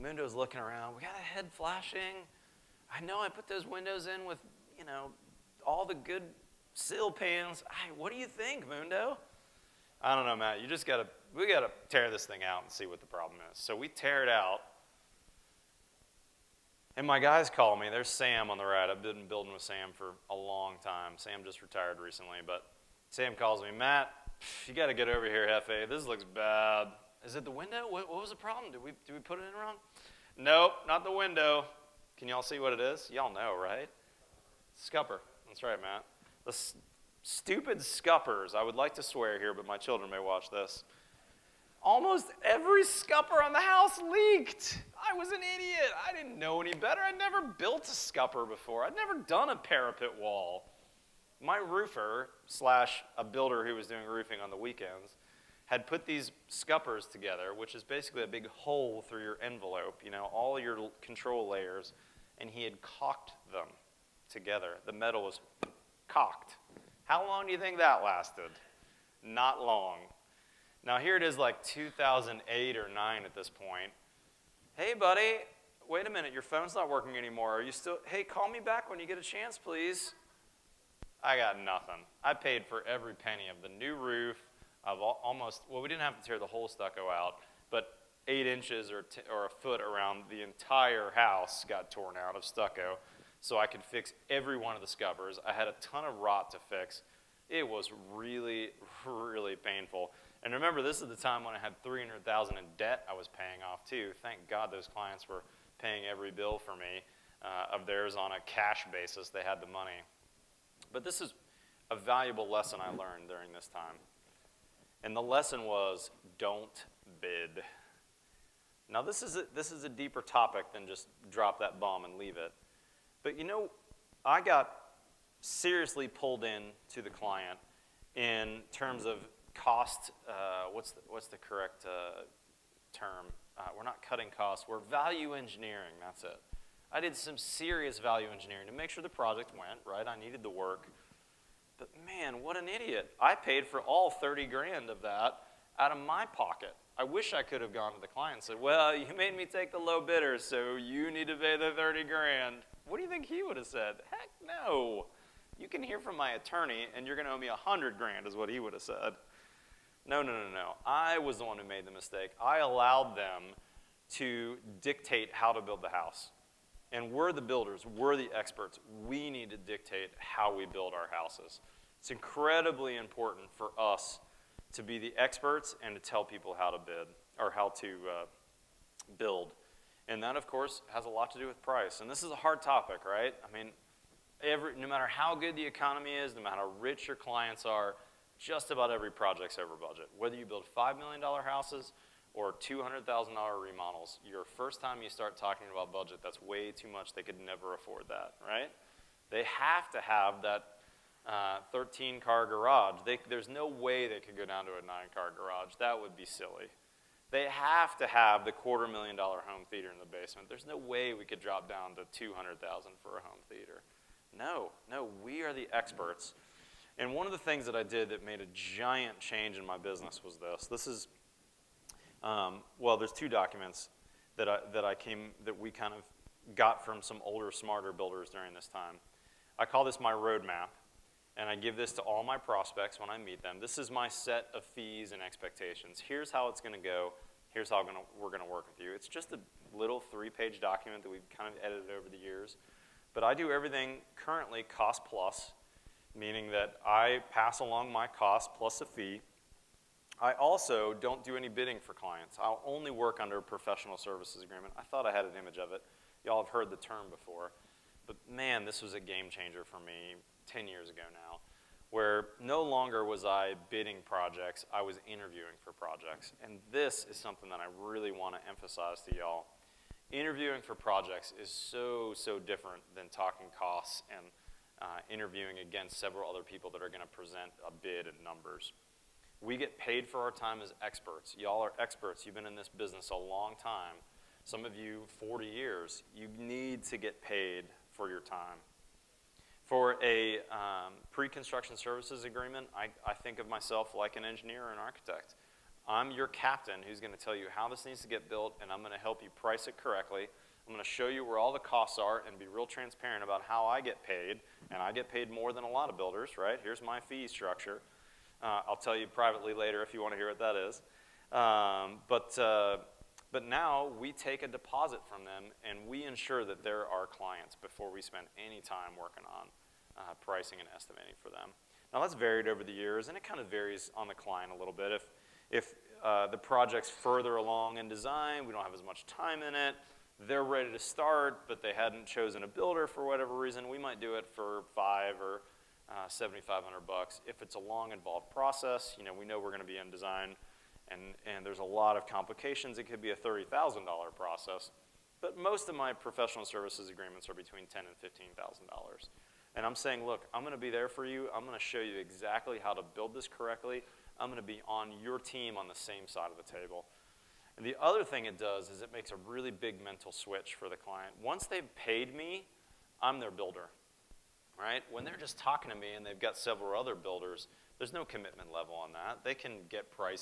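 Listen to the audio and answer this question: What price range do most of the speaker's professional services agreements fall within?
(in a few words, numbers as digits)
$10,000 to $15,000.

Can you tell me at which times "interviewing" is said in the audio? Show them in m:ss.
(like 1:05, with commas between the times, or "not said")
4:25, 4:30, 4:35.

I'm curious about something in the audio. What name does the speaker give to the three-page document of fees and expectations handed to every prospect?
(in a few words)
Roadmap.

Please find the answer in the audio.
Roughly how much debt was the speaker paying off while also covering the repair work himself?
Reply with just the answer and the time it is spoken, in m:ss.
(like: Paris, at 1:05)
300000, at 1:41.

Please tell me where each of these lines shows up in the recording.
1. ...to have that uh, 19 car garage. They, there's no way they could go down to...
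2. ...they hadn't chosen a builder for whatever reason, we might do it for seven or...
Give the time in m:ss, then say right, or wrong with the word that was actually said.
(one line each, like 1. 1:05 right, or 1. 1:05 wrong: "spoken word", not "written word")
1. 3:19 wrong: "13", not "19"
2. 5:31 wrong: "five", not "seven".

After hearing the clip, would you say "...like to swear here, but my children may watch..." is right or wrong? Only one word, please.
right.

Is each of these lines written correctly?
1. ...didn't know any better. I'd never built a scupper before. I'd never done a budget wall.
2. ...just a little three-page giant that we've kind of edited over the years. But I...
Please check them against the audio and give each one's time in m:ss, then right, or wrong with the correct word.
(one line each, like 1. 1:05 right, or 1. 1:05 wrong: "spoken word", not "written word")
1. 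0:46 wrong: "parapet", not "budget"
2. 3:59 wrong: "document", not "giant".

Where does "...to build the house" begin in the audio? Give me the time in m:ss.
2:45.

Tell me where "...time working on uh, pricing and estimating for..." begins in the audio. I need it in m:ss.
5:18.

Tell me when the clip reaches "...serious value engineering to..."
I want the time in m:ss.
2:17.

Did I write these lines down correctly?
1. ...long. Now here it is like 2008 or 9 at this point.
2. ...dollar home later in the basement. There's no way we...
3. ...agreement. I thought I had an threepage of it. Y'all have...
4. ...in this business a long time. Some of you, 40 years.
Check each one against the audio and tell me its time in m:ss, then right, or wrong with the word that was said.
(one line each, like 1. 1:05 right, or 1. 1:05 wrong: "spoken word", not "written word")
1. 1:09 right
2. 3:29 wrong: "theater", not "later"
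3. 4:14 wrong: "image", not "threepage"
4. 4:42 right.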